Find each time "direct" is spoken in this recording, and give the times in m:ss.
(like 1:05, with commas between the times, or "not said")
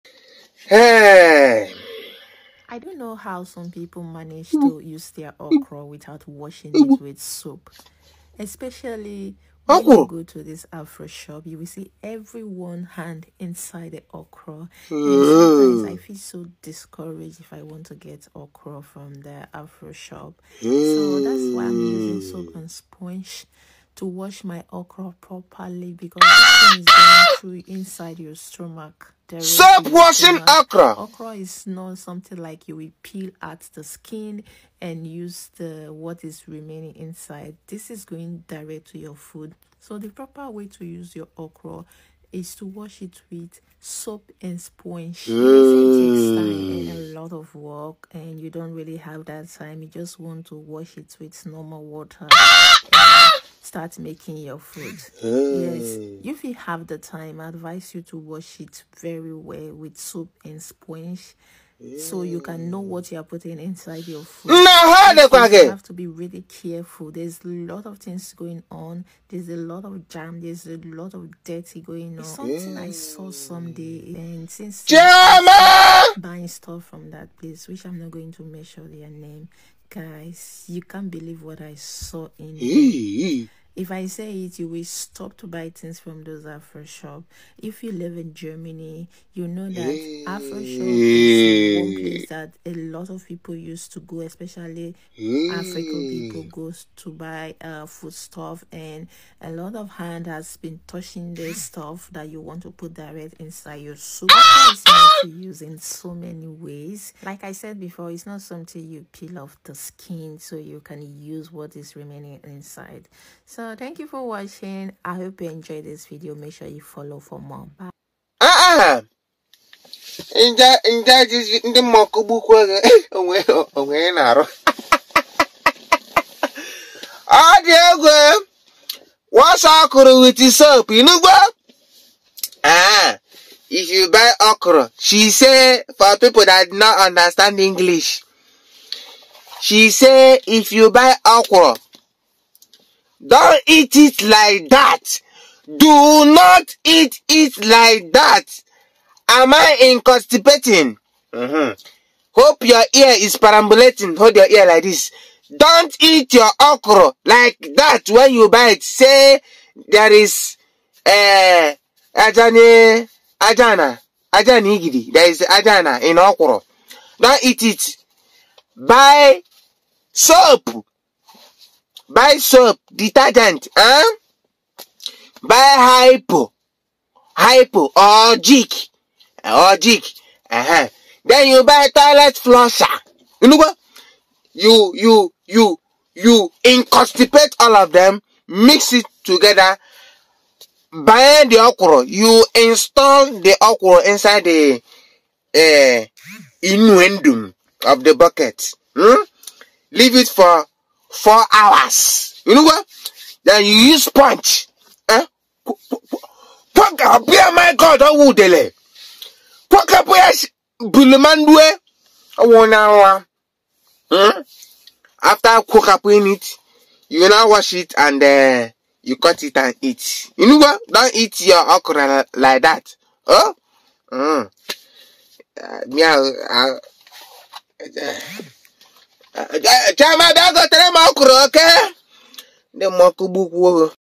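0:38, 1:42.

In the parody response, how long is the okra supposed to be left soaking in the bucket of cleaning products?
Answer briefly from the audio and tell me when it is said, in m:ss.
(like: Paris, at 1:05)
4 hours, at 3:21.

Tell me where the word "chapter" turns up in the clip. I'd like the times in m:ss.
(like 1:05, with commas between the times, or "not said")
not said.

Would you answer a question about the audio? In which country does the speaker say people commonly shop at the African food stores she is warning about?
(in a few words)
Germany.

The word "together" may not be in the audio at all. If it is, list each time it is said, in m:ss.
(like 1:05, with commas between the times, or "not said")
3:09.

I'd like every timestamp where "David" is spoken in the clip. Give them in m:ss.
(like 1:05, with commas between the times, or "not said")
not said.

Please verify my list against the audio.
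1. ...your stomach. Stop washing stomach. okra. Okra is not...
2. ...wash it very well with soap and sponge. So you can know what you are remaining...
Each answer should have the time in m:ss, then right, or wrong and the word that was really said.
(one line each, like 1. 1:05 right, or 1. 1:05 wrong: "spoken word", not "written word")
1. 0:28 right
2. 0:58 wrong: "putting", not "remaining".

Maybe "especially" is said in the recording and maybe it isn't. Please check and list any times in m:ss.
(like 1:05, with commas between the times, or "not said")
0:08, 1:34.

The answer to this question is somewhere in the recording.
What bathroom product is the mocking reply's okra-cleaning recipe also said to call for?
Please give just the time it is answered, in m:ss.
3:01.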